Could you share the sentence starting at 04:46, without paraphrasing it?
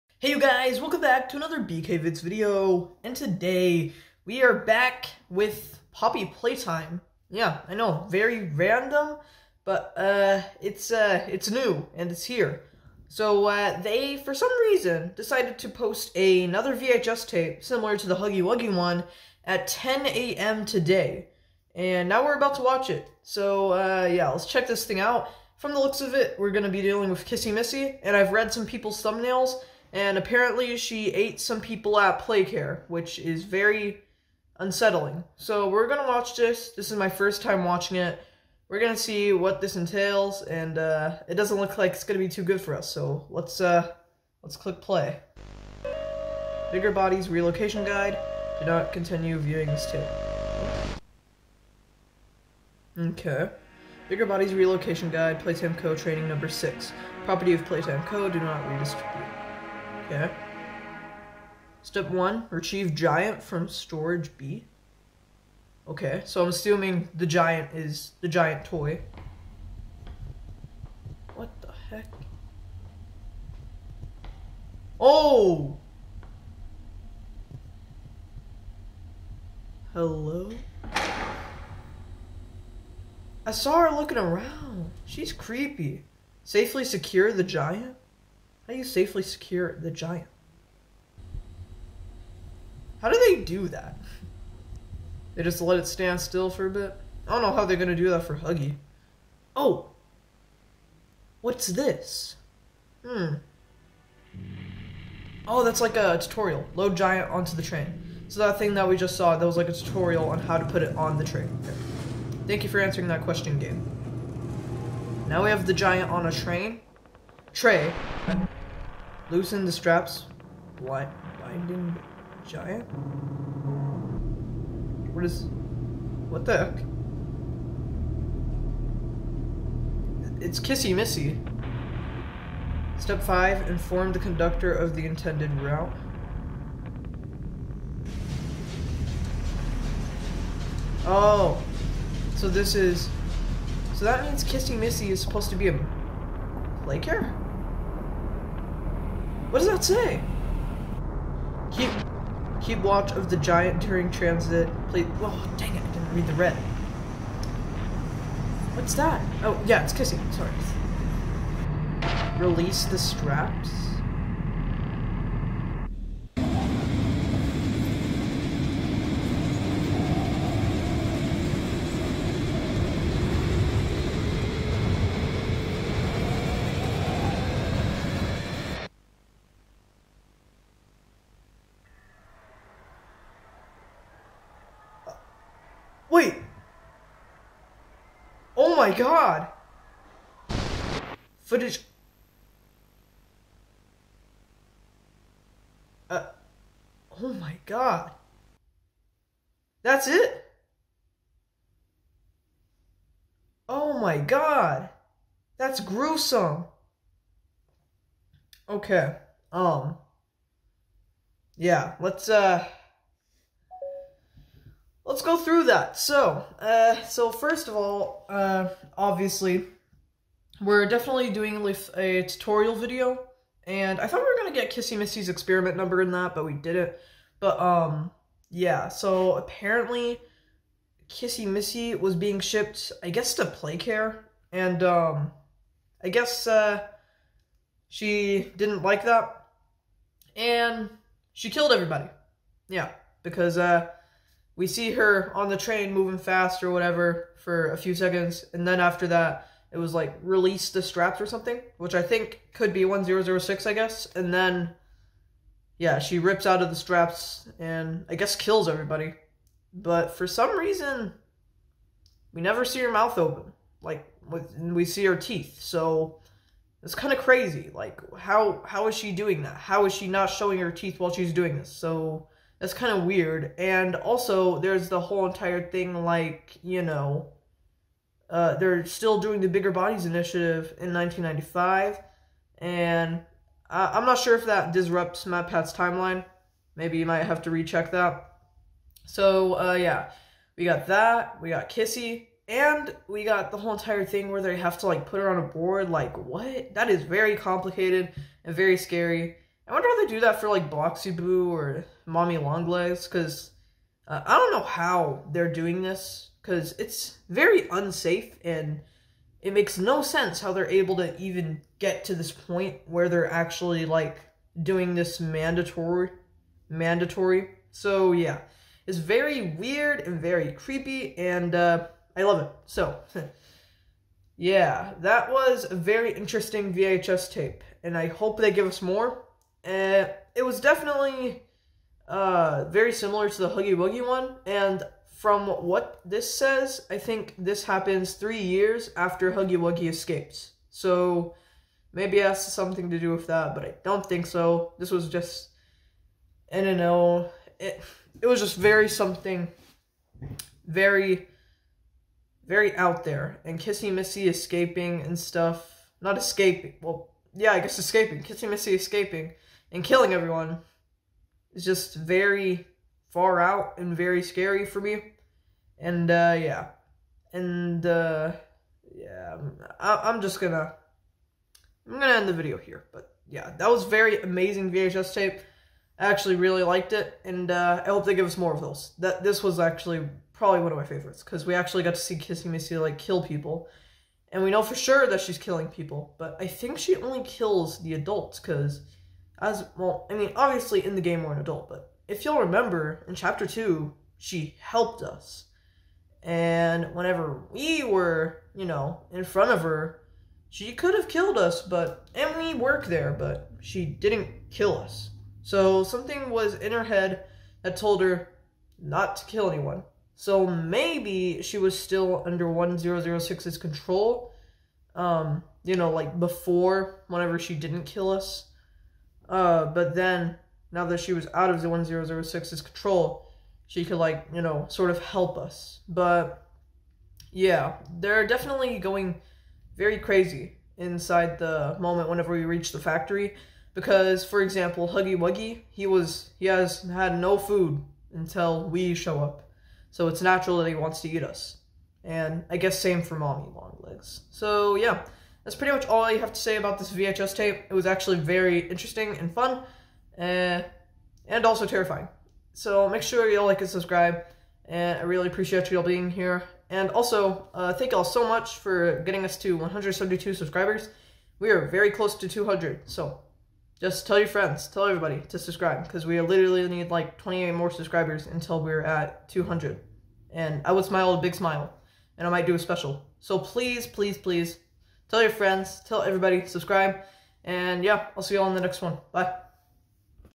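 Maybe you might have to recheck that.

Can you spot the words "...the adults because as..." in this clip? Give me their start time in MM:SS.
06:27.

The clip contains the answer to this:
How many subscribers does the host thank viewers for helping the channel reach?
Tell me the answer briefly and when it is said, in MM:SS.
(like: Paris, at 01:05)
172, at 07:39.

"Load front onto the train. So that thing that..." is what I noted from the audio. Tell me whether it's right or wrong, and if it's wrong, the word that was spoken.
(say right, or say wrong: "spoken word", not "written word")
wrong: "giant", not "front".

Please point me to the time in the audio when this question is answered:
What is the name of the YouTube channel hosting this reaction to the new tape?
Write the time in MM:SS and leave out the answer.
00:01.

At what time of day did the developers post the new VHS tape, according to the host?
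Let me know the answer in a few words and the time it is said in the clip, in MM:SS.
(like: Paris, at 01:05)
10 a.m., at 00:19.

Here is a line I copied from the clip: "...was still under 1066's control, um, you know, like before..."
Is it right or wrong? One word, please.
wrong.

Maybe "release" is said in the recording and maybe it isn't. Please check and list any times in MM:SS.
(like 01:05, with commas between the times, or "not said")
02:42, 04:10.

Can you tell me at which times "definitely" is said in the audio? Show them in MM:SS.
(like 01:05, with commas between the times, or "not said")
03:40, 05:30, 07:08.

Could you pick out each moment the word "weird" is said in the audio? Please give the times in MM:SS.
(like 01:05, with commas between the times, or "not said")
04:33, 05:19.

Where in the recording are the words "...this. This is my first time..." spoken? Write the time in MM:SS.
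00:36.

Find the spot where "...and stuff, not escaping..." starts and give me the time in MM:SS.
05:55.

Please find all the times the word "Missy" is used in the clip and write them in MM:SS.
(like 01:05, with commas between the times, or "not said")
00:27, 02:10, 02:24, 03:44, 03:51, 05:53, 05:58, 06:22.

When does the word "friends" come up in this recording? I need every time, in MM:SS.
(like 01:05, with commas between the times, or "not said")
07:44, 07:55.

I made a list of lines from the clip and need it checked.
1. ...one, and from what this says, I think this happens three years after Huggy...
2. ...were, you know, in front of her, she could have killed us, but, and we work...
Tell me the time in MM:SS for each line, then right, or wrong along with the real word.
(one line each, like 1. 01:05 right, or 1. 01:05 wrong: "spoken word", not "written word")
1. 05:34 right
2. 06:37 right.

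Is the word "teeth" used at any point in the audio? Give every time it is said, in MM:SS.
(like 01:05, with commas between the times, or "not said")
04:25, 04:30.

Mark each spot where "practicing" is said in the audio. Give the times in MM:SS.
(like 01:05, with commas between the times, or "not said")
not said.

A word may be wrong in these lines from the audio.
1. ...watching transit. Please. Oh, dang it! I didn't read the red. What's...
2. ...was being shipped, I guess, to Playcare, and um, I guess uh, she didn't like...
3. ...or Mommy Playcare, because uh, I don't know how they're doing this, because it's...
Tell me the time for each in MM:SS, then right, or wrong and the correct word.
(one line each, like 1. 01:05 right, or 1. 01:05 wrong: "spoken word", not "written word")
1. 02:33 wrong: "during", not "watching"
2. 03:51 right
3. 05:01 wrong: "Longlegs", not "Playcare".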